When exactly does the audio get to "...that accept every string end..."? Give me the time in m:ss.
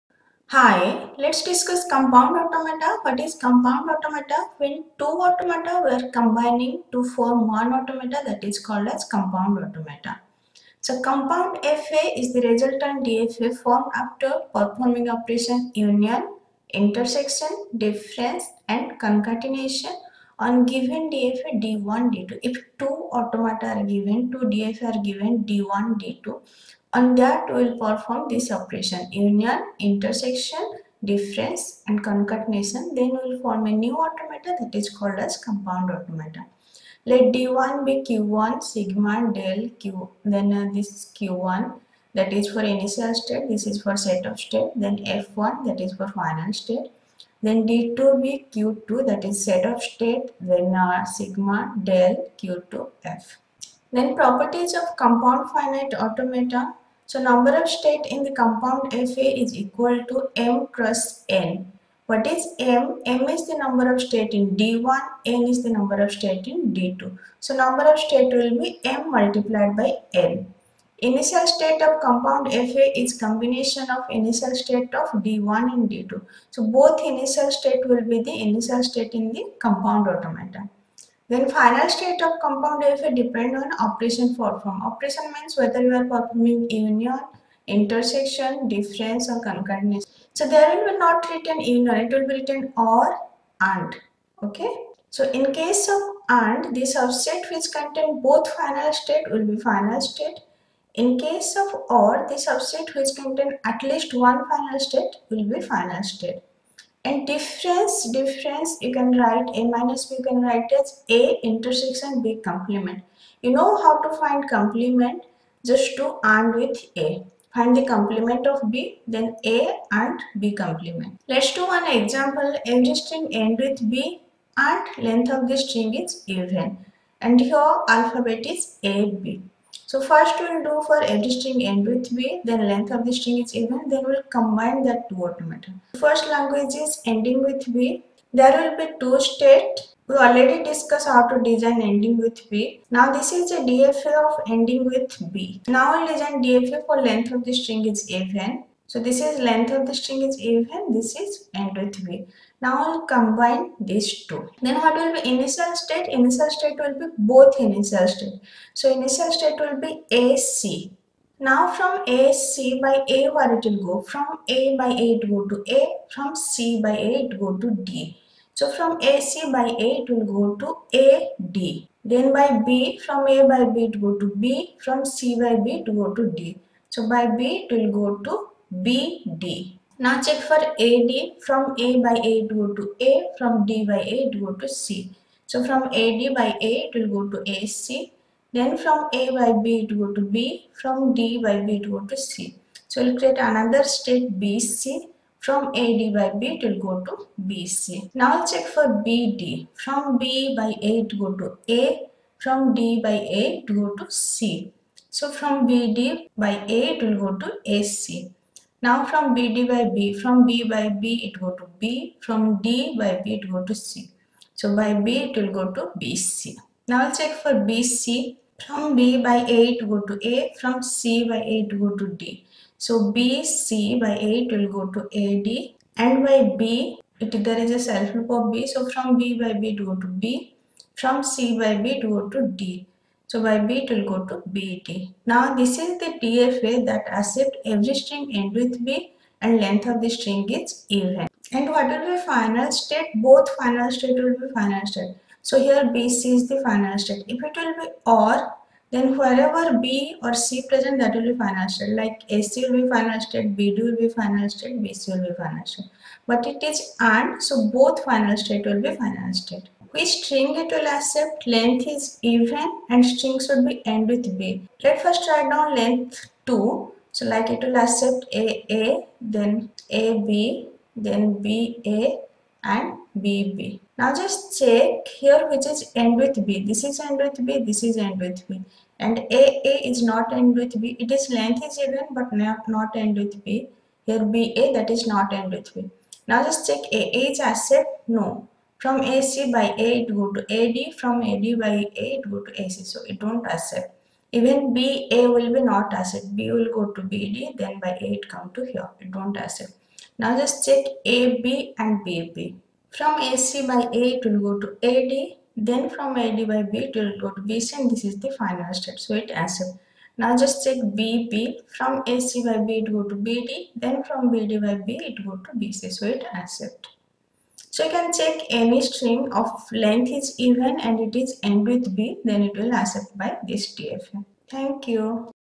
3:56.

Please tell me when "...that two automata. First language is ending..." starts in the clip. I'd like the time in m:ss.
2:14.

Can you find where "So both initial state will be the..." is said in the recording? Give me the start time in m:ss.
1:16.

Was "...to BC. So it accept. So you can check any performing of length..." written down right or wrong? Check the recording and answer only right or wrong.
wrong.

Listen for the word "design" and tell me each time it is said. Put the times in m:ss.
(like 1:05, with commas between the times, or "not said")
2:21, 2:26.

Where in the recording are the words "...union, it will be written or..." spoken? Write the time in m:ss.
1:31.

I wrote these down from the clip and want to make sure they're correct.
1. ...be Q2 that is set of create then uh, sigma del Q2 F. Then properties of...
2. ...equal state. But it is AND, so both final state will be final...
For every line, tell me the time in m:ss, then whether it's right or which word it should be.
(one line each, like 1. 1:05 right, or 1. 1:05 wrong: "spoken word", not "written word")
1. 0:48 wrong: "state", not "create"
2. 4:15 wrong: "final", not "equal".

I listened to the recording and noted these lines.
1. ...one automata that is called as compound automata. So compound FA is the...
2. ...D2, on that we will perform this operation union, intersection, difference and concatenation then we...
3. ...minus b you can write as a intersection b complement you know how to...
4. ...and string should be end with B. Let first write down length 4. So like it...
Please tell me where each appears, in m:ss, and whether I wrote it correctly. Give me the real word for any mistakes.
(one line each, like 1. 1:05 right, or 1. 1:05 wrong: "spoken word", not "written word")
1. 0:07 right
2. 0:26 right
3. 1:49 right
4. 4:22 wrong: "2", not "4".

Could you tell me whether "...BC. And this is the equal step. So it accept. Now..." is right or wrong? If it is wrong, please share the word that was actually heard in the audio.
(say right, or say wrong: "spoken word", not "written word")
wrong: "final", not "equal".